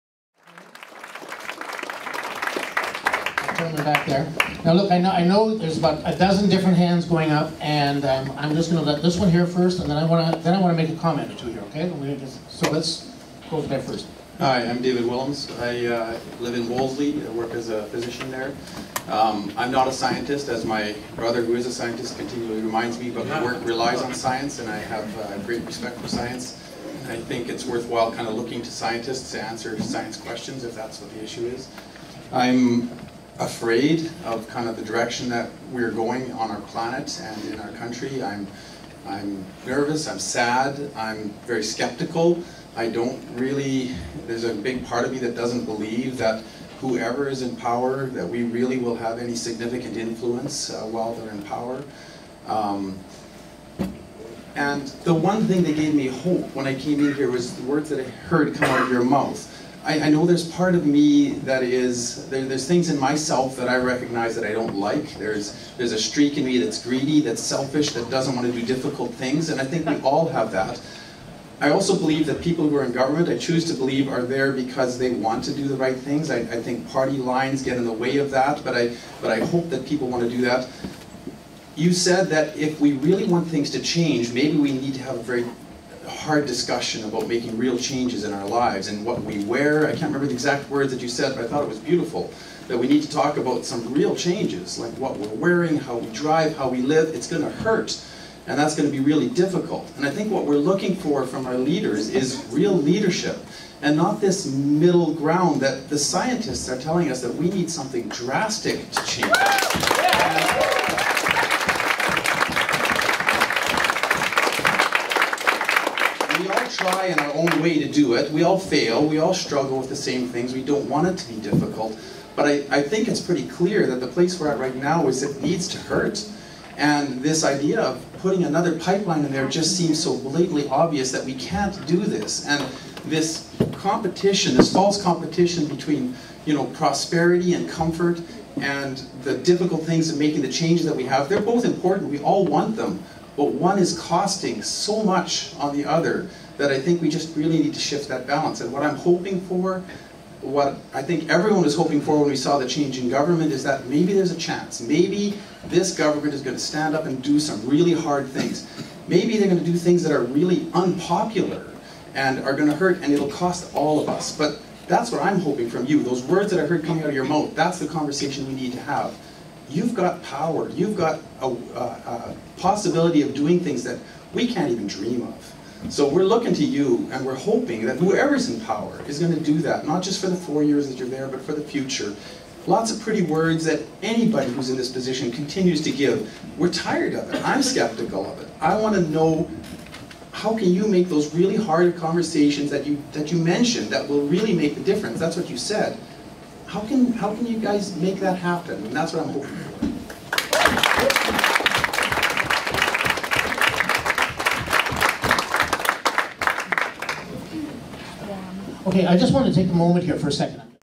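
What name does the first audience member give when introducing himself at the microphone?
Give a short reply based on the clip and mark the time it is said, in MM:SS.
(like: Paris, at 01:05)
David Willems, at 00:14.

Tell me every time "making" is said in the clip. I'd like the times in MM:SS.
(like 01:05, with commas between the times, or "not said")
01:27, 02:20.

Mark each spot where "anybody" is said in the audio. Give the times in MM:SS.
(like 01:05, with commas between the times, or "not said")
03:04.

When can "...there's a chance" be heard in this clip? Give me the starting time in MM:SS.
02:34.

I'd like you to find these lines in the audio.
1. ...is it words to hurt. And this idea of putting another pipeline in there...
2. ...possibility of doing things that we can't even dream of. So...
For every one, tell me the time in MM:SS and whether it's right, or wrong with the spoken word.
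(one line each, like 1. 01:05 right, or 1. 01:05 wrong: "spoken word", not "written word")
1. 02:05 wrong: "needs", not "words"
2. 02:52 right.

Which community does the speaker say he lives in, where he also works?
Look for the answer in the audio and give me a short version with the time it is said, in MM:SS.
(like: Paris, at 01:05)
Wolseley, at 00:16.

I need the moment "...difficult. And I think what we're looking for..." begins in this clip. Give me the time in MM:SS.
01:39.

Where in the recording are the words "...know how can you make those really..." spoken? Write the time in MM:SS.
03:09.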